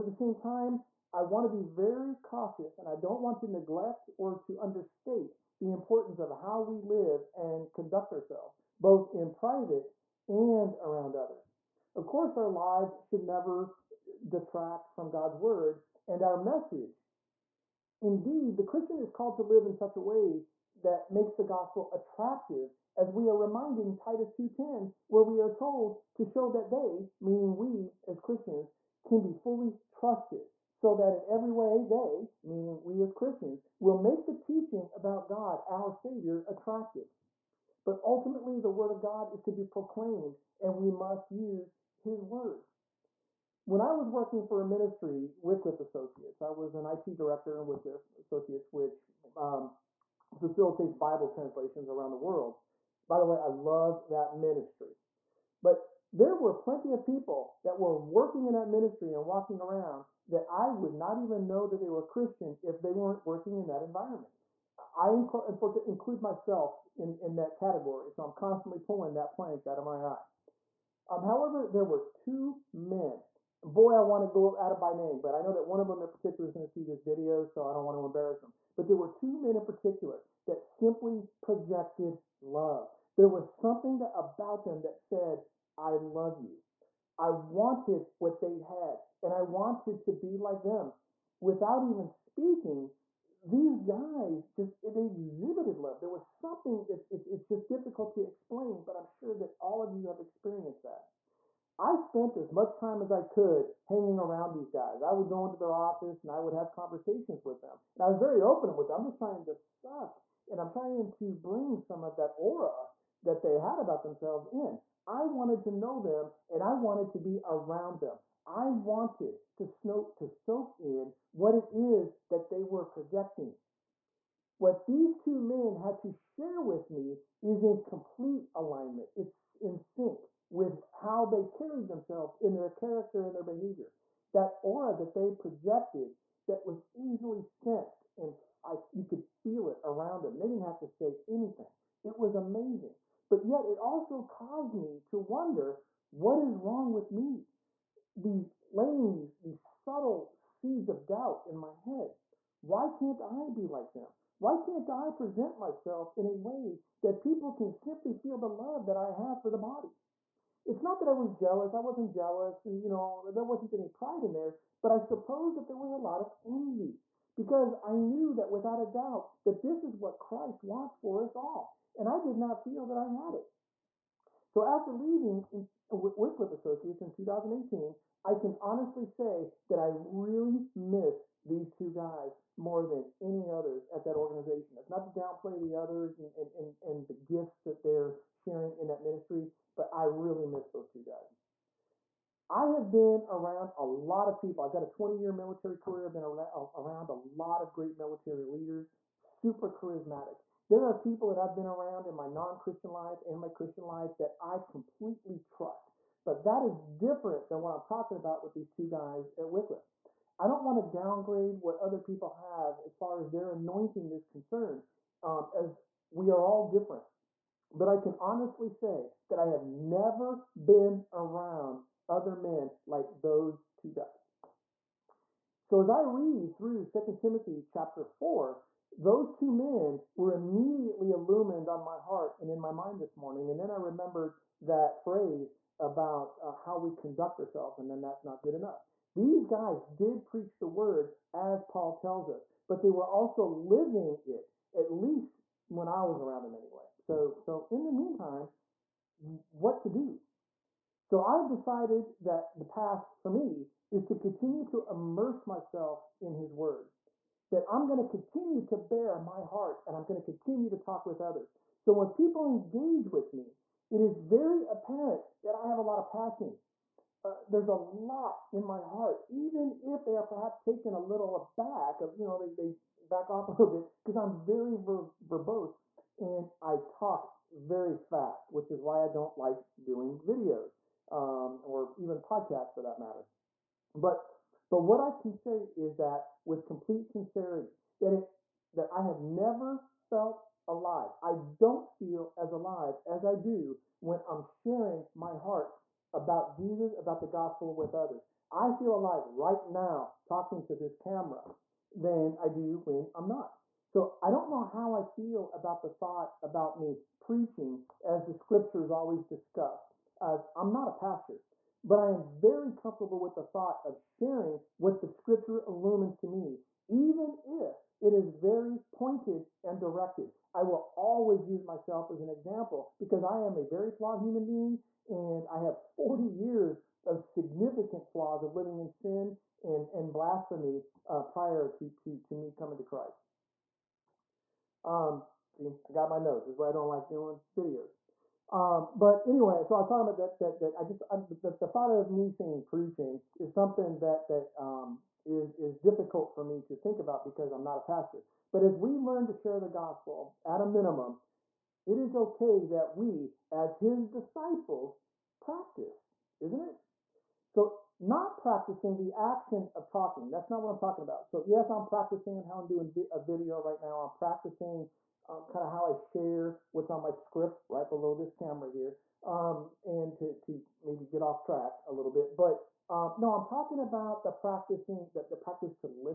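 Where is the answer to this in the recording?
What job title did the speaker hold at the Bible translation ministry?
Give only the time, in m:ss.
0:46.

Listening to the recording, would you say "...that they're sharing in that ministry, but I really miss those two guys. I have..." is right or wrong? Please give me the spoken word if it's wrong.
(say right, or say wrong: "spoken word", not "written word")
right.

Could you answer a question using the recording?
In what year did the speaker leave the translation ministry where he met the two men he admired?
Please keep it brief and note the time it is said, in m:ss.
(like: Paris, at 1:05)
2018, at 2:57.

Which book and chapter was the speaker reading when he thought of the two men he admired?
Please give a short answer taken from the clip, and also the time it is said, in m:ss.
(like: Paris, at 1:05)
2 Timothy chapter 4, at 3:46.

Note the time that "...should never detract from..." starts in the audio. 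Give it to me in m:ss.
0:13.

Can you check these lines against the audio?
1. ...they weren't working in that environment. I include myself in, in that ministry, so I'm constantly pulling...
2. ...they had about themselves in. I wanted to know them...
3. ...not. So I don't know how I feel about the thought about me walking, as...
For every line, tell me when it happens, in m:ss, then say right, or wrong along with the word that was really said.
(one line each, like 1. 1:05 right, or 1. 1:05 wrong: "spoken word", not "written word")
1. 1:02 wrong: "category", not "ministry"
2. 1:53 right
3. 5:03 wrong: "preaching", not "walking".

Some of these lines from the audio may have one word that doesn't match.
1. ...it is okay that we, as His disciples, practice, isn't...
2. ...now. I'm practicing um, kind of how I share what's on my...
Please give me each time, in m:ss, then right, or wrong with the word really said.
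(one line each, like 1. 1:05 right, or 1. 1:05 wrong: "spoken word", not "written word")
1. 5:51 right
2. 6:03 right.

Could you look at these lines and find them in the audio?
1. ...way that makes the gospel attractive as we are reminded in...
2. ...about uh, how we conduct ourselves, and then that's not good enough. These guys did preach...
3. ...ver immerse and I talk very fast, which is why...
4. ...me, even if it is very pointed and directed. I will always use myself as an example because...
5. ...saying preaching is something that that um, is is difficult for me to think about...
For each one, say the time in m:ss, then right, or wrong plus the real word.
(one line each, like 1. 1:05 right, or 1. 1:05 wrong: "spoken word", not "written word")
1. 0:20 right
2. 3:55 right
3. 4:34 wrong: "verbose", not "immerse"
4. 5:16 right
5. 5:42 right.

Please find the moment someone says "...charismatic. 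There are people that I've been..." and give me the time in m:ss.
3:19.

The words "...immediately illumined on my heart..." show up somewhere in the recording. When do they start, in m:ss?
3:50.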